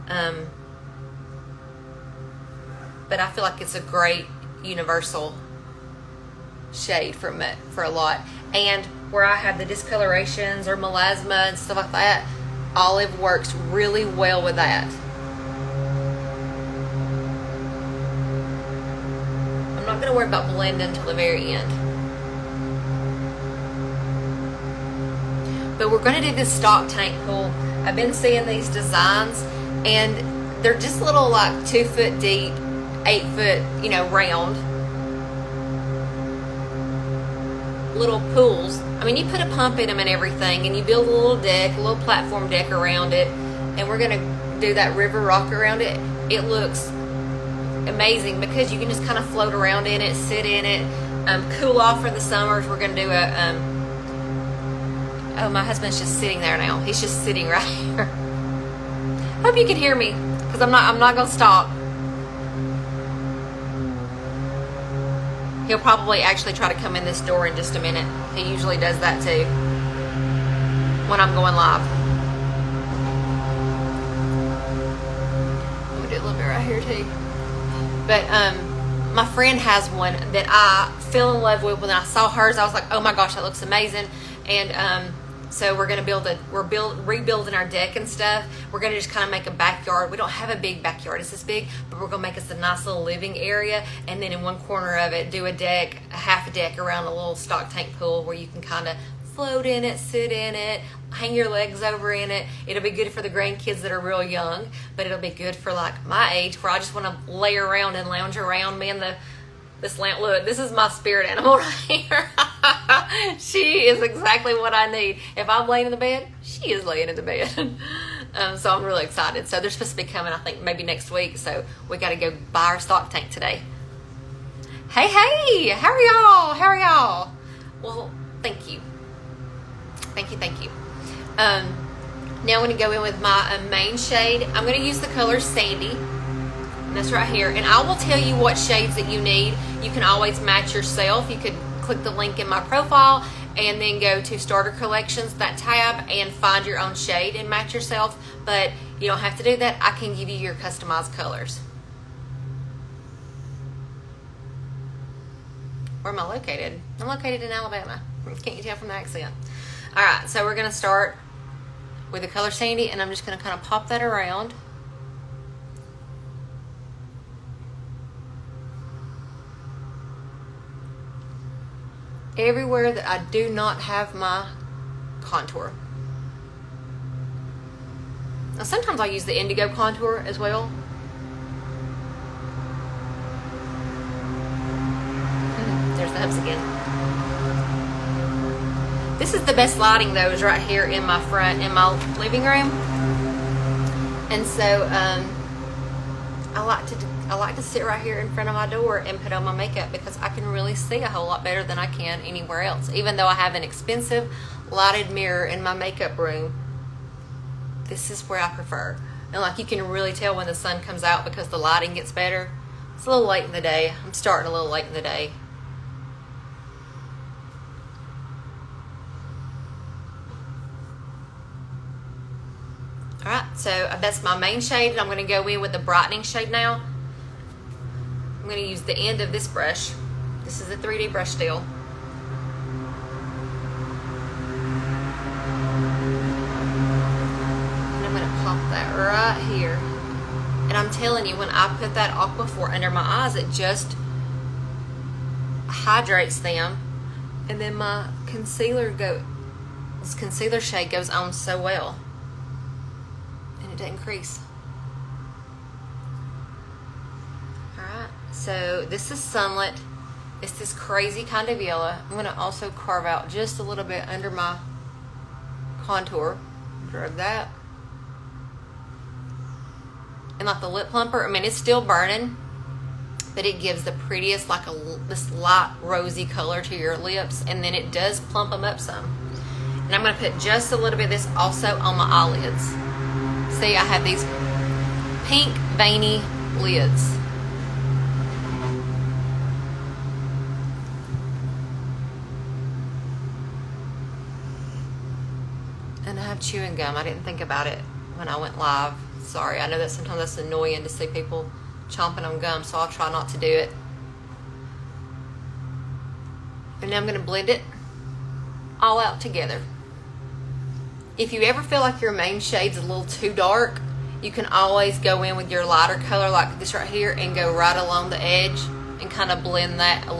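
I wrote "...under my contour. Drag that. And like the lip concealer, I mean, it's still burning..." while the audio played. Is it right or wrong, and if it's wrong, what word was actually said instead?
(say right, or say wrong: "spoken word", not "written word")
wrong: "plumper", not "concealer".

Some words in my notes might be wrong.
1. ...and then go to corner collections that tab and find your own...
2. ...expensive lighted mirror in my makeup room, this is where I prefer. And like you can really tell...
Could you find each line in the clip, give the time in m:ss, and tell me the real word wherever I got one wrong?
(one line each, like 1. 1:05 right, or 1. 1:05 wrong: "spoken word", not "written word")
1. 2:23 wrong: "starter", not "corner"
2. 3:23 right.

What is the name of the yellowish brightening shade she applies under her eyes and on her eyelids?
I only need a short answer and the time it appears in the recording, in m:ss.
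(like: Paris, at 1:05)
Sunlit, at 4:19.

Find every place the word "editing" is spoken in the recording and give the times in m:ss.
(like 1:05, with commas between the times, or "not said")
not said.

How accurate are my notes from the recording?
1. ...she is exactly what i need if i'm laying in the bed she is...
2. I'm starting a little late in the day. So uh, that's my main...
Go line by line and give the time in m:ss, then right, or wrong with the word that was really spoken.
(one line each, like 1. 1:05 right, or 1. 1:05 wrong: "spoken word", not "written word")
1. 1:53 right
2. 3:34 right.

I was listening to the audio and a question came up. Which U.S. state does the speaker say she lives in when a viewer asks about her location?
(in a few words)
Alabama.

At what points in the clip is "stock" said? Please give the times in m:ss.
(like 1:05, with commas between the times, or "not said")
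0:26, 1:37, 2:02.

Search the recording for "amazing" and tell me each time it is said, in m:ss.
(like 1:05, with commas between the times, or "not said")
0:47, 1:23.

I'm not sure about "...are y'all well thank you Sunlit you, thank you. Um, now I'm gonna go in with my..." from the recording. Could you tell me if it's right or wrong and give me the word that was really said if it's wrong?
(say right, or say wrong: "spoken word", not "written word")
wrong: "Thank", not "Sunlit".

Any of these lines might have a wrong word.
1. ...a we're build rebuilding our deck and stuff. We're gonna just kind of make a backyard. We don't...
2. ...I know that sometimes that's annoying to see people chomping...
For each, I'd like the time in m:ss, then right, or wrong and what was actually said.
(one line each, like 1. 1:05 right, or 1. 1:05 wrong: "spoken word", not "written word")
1. 1:26 right
2. 4:59 right.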